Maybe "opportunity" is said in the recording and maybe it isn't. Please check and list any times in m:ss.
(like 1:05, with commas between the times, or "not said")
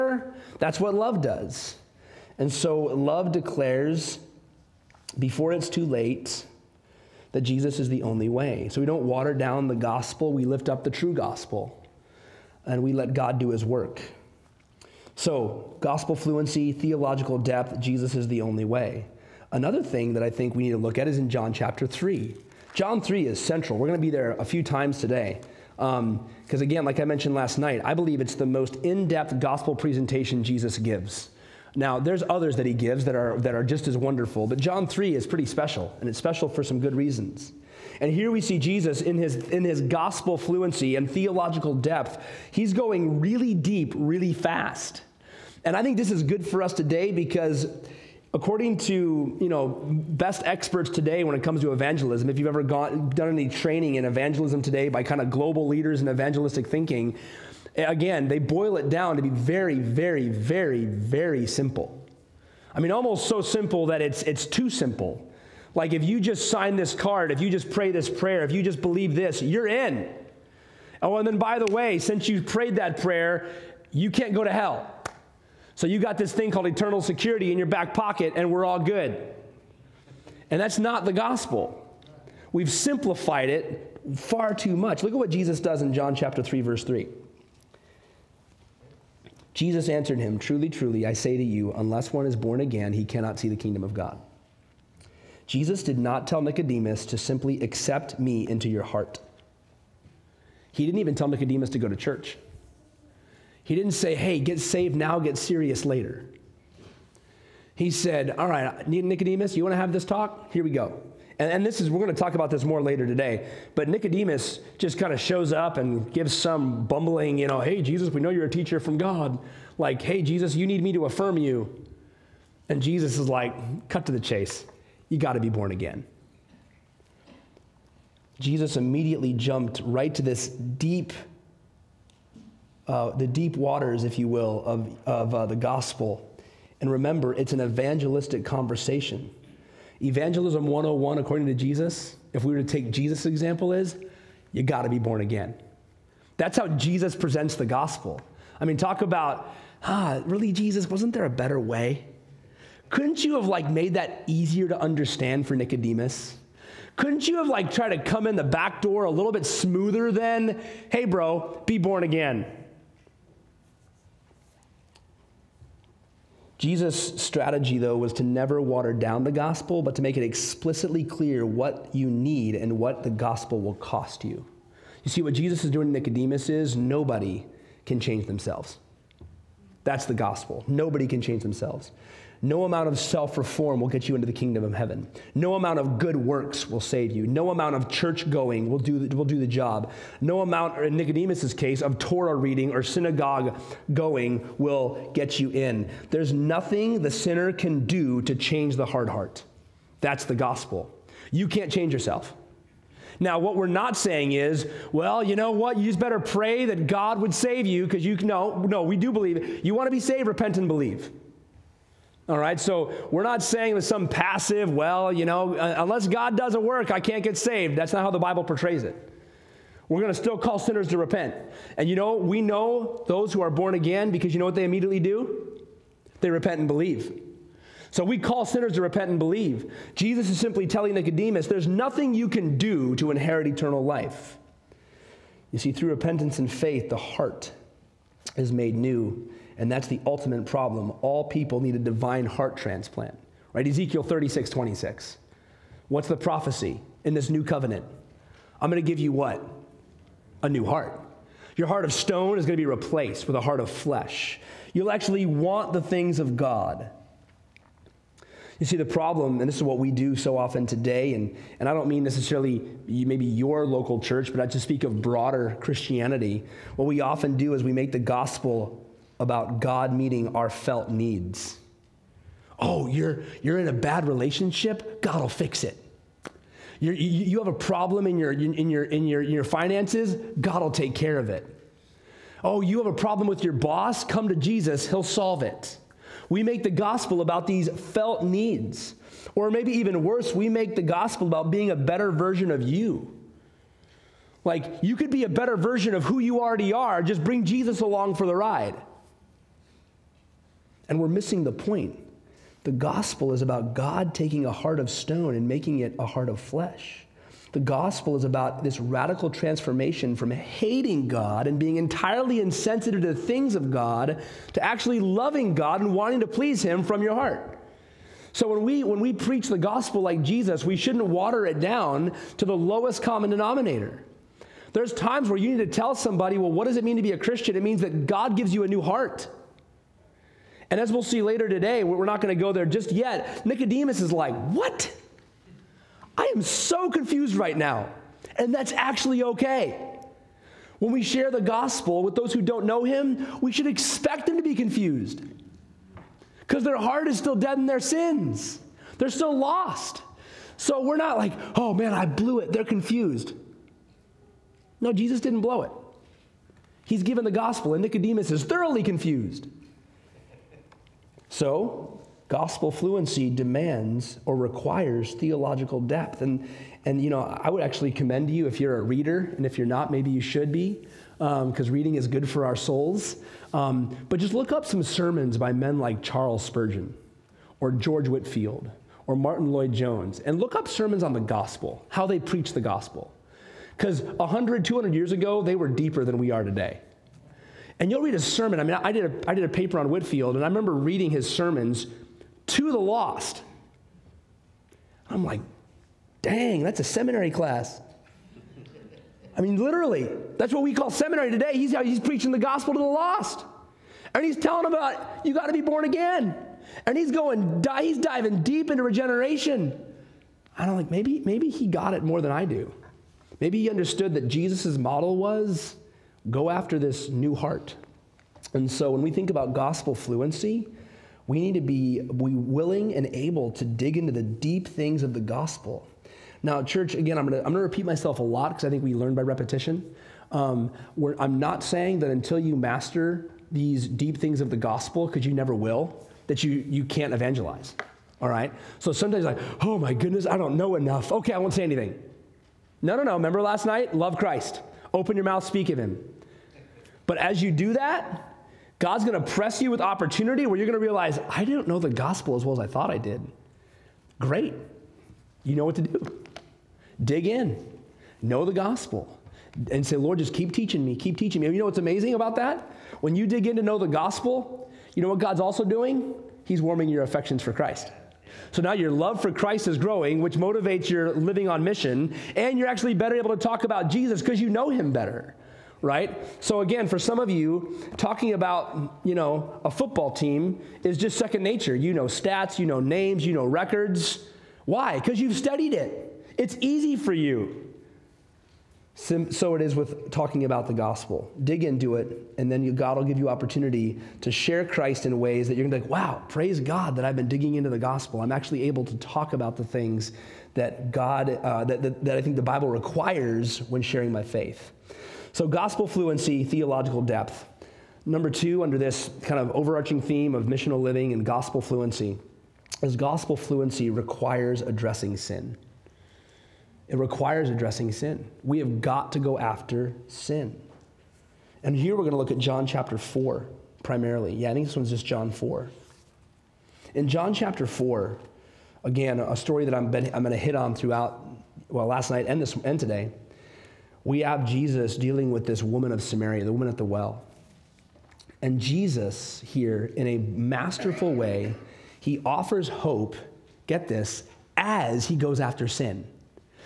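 7:29, 8:13.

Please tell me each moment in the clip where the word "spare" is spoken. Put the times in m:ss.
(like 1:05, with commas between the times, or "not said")
not said.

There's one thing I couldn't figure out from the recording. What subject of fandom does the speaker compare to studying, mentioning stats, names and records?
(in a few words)
A football team.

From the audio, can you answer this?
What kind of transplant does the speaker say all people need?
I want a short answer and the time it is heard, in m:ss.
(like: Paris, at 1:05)
A divine heart transplant, at 4:01.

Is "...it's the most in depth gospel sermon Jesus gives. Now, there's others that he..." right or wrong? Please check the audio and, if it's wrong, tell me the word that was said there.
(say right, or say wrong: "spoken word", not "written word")
wrong: "presentation", not "sermon".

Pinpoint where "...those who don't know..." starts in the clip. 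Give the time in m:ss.
5:42.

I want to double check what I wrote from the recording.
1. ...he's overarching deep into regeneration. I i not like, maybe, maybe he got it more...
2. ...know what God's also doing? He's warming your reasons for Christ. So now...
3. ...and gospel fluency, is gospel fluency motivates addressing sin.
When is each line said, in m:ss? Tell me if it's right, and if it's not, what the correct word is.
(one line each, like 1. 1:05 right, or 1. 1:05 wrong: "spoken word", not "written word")
1. 6:47 wrong: "diving", not "overarching"
2. 7:45 wrong: "affections", not "reasons"
3. 8:31 wrong: "requires", not "motivates".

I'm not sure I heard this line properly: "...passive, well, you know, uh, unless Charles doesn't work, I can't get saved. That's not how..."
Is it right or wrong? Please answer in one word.
wrong.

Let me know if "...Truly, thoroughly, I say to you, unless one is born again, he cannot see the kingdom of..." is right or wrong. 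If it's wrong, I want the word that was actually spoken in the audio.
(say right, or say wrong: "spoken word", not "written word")
wrong: "truly", not "thoroughly".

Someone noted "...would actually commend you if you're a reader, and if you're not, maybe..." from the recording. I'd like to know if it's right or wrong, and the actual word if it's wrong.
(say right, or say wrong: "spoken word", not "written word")
right.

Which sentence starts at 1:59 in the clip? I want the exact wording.
Like, hey, Jesus, you need me to affirm you.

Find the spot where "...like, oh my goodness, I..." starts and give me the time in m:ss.
7:19.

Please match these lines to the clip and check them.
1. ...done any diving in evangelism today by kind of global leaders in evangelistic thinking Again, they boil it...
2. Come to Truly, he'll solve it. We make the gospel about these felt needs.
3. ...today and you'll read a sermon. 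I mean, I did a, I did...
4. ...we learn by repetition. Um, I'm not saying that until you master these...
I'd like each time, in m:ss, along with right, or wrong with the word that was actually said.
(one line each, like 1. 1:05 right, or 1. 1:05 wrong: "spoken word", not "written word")
1. 0:53 wrong: "training", not "diving"
2. 4:44 wrong: "Jesus", not "Truly"
3. 6:26 right
4. 7:08 right.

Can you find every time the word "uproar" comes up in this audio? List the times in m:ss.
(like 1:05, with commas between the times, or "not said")
not said.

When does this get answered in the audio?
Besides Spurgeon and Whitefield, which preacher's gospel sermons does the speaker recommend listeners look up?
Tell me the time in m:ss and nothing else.
6:19.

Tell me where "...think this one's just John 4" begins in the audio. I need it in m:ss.
8:44.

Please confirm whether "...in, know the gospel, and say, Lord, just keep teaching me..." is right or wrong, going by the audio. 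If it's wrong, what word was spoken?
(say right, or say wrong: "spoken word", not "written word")
right.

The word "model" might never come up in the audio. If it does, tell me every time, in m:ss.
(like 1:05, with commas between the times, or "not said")
6:54.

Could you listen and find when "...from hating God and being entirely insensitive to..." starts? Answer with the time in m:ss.
5:10.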